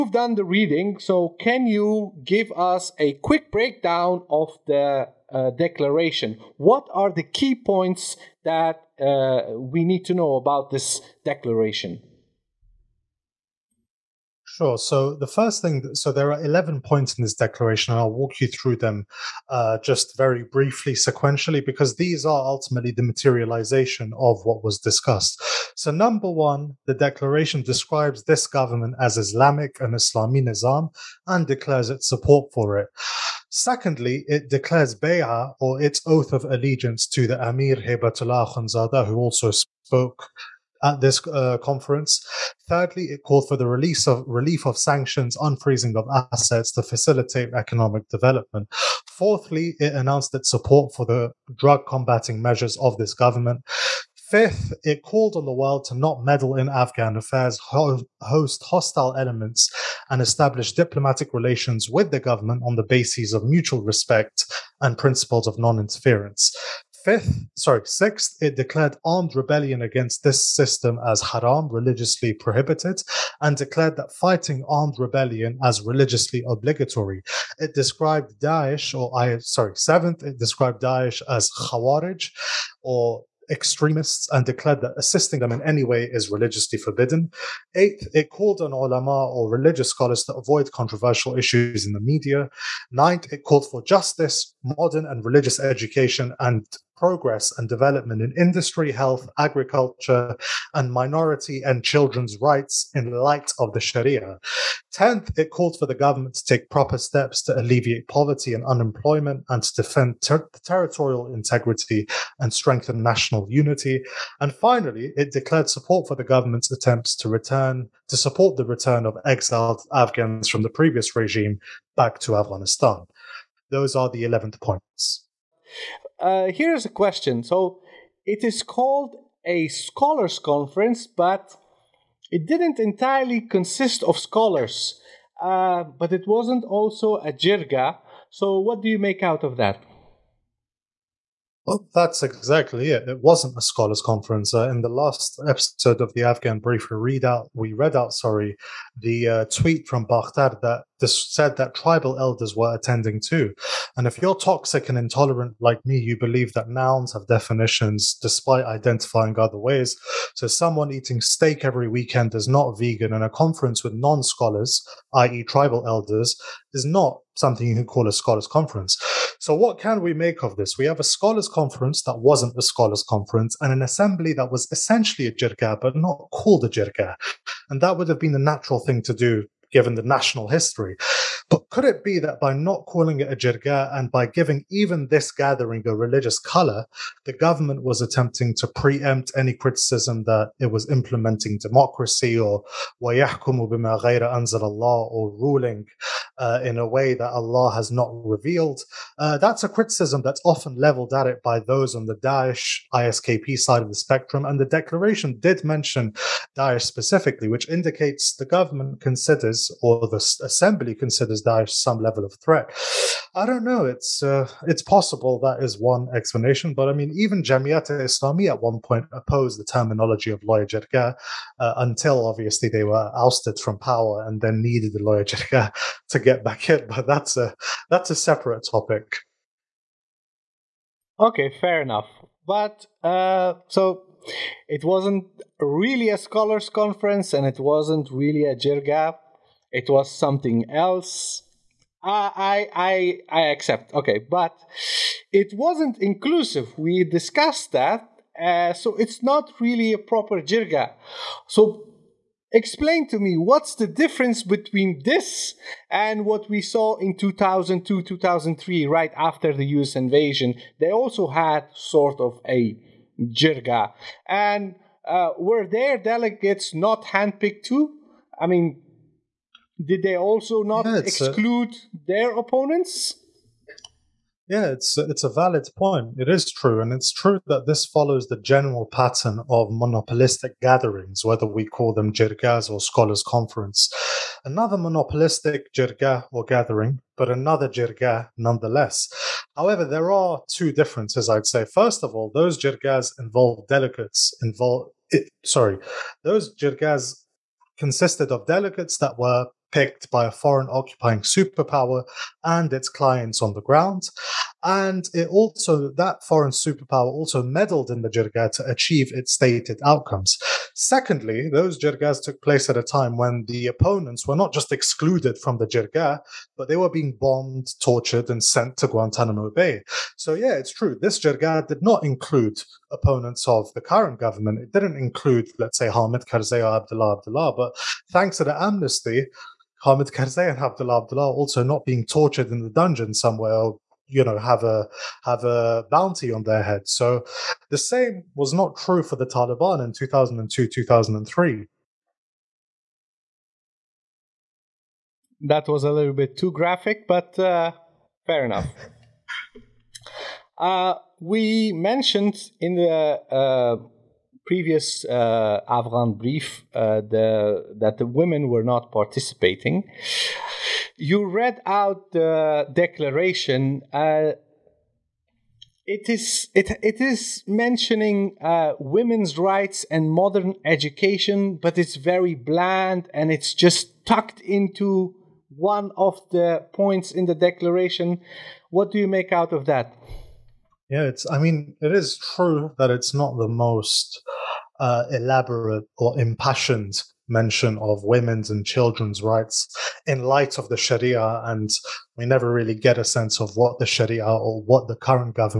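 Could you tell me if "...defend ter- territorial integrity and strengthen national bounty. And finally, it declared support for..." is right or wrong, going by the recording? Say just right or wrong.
wrong.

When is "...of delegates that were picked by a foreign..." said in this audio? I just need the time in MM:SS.
04:58.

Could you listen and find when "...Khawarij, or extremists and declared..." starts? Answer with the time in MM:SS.
01:21.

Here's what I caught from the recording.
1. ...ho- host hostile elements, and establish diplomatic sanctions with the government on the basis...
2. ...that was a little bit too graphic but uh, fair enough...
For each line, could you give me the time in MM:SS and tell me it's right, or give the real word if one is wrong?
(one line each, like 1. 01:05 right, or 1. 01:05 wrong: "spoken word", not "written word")
1. 00:57 wrong: "relations", not "sanctions"
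2. 05:45 right.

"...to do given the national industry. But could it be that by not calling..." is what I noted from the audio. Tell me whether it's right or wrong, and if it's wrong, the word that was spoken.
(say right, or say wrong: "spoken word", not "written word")
wrong: "history", not "industry".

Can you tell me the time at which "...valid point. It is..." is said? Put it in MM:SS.
04:35.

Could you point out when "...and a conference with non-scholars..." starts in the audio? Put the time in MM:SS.
02:43.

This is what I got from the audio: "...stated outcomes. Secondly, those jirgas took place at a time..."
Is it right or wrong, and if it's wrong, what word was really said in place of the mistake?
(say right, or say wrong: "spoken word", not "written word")
right.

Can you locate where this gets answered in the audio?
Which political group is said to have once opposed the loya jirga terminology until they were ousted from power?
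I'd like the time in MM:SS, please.
03:37.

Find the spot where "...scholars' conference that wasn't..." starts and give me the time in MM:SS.
02:51.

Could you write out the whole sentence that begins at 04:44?
Another monopolistic jirga or gathering, but another jirga nonetheless.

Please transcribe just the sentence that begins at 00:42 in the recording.
Thirdly, it called for the release of relief of sanctions, unfreezing of assets to facilitate economic development.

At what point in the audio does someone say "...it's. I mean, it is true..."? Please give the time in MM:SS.
06:21.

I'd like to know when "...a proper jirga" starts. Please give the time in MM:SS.
04:09.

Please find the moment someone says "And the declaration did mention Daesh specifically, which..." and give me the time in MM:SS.
03:24.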